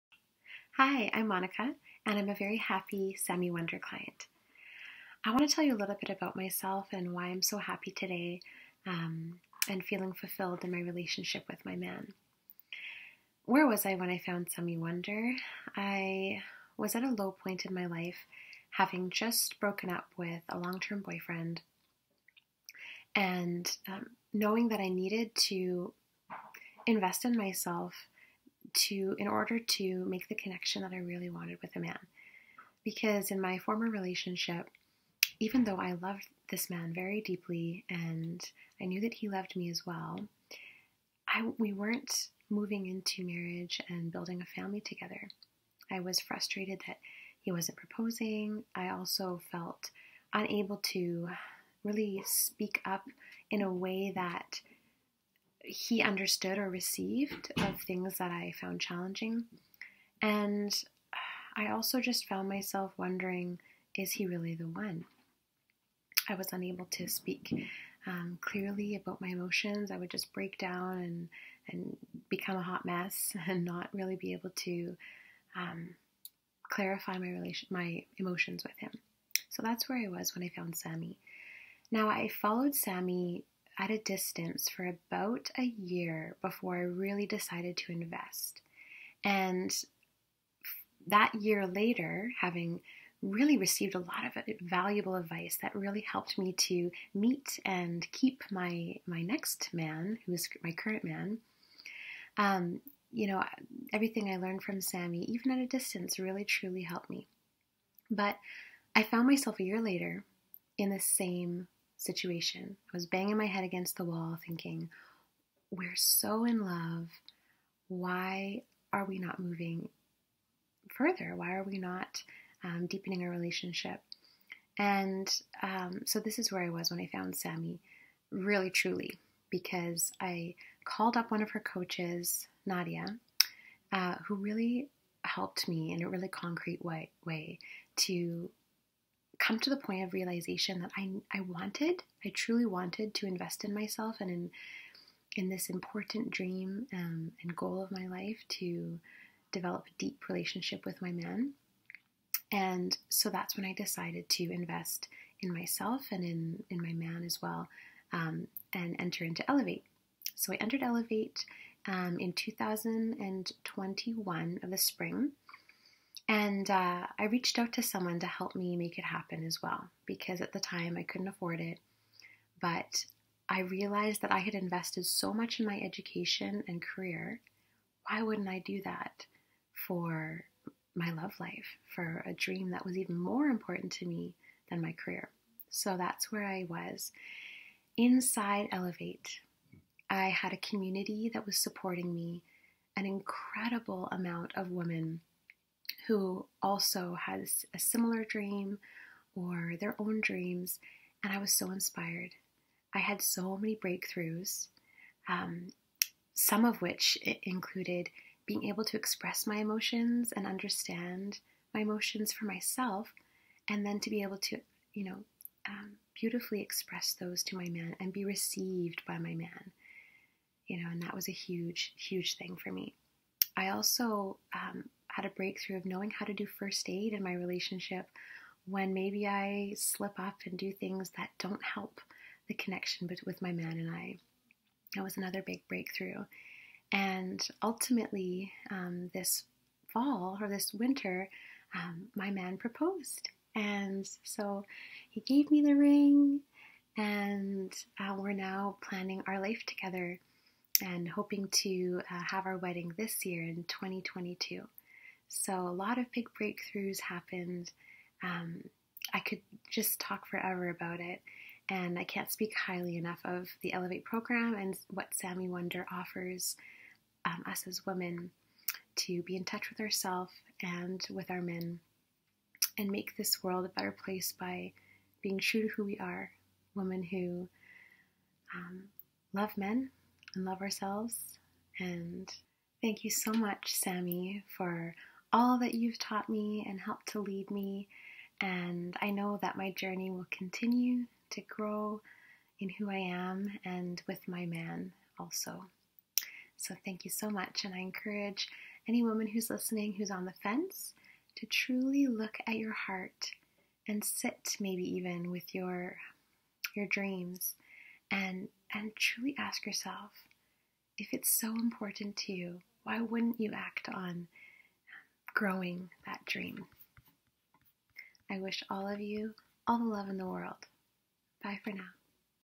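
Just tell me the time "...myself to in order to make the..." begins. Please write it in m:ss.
0:27.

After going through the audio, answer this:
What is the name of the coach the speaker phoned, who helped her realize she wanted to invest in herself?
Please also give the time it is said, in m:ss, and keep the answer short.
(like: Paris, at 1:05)
Nadia, at 2:12.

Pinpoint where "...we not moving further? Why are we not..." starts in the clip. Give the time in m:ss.
1:59.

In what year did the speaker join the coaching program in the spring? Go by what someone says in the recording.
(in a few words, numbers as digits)
2021.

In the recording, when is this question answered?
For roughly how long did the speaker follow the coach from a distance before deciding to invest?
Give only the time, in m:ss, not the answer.
1:24.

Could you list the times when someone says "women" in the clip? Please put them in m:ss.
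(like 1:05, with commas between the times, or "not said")
3:14, 4:27, 4:36.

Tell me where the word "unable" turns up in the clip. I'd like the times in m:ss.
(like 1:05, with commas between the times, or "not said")
0:50, 1:06.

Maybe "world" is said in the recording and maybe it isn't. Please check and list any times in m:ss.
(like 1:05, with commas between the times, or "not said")
4:33, 5:20.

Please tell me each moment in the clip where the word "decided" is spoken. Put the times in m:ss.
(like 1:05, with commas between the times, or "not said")
1:27, 2:33.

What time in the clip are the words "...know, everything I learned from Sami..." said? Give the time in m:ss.
1:43.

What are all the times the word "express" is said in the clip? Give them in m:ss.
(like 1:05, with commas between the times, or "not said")
3:28, 3:36.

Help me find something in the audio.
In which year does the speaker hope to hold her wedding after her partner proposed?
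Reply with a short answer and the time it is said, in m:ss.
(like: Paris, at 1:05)
2022, at 4:13.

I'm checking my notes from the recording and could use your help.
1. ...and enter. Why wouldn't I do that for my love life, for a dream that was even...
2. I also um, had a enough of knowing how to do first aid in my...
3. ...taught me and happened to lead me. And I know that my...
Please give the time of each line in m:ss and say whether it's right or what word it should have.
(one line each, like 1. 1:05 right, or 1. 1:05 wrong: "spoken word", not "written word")
1. 2:56 wrong: "career", not "enter"
2. 3:43 wrong: "breakthrough", not "enough"
3. 4:45 wrong: "helped", not "happened".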